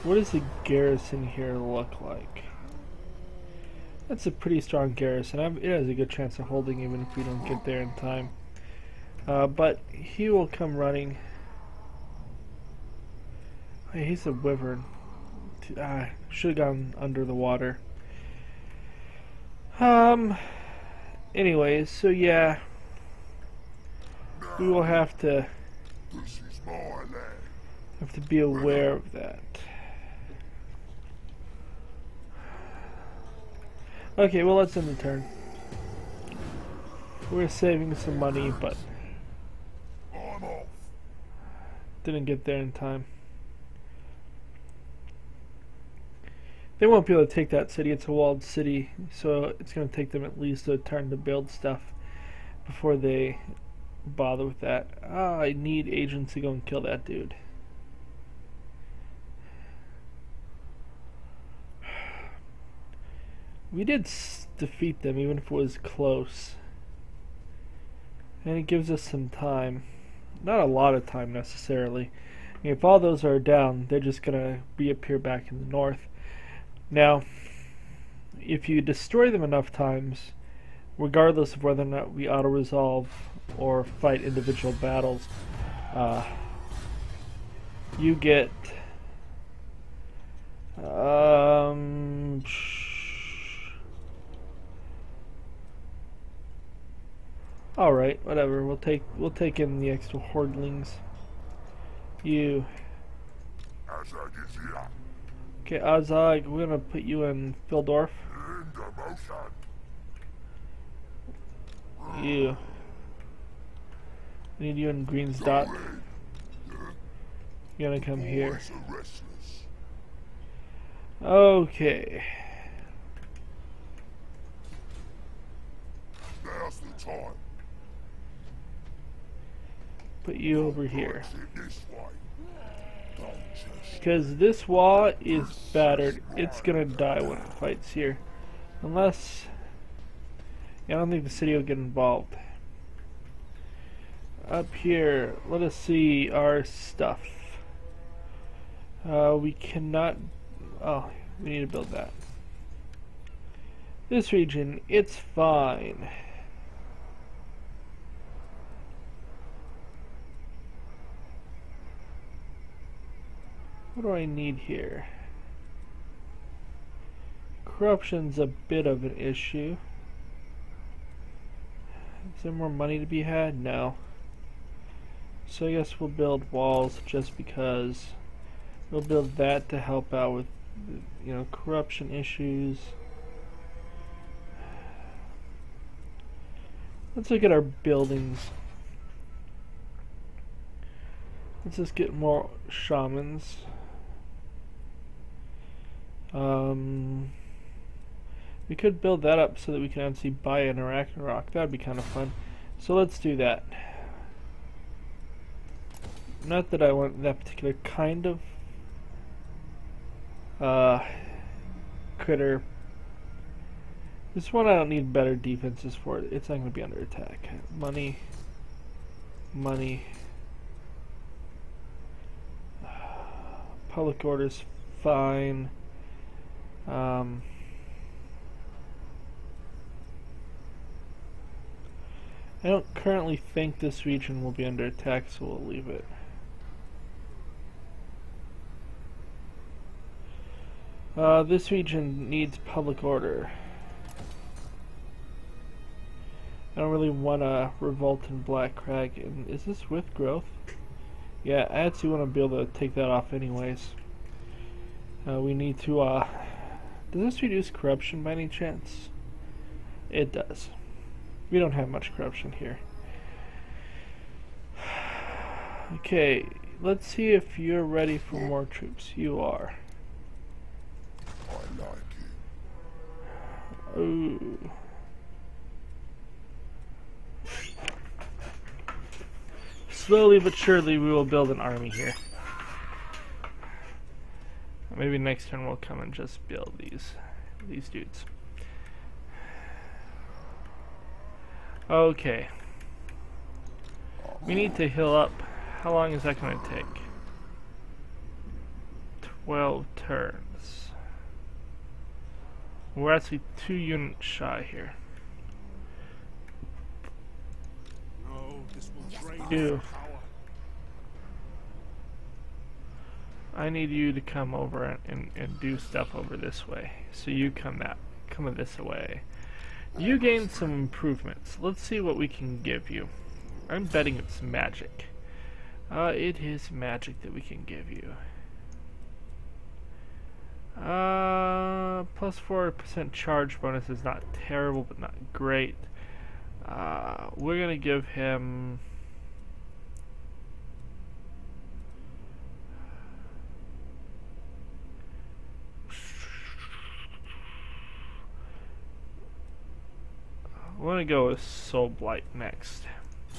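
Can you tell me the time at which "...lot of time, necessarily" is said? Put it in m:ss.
1:10.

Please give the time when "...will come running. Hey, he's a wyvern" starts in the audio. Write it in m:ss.
0:10.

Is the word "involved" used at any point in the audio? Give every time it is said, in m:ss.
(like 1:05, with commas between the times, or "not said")
2:21.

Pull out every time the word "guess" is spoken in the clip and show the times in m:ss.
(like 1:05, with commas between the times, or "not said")
2:55.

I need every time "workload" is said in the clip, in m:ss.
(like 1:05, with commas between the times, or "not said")
not said.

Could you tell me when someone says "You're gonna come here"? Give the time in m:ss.
1:57.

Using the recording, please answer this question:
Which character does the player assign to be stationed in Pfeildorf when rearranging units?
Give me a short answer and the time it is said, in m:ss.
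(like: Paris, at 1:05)
Azhag, at 1:45.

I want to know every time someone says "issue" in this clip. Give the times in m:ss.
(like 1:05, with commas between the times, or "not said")
2:49, 3:02.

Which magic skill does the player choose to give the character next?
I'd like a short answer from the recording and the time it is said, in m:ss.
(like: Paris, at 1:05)
Soul Blight, at 5:51.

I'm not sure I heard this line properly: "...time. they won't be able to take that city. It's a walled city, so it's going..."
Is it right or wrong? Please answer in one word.
right.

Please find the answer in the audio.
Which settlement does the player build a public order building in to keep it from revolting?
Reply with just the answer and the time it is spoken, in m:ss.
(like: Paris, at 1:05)
Black Crag, at 4:08.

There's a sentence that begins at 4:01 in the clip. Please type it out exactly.
Uh, this region needs public order.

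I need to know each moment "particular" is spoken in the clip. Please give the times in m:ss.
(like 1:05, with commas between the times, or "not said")
3:27.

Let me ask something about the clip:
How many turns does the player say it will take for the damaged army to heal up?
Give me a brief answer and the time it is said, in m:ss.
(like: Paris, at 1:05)
12, at 4:59.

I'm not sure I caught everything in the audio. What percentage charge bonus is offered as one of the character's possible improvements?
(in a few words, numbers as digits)
4%.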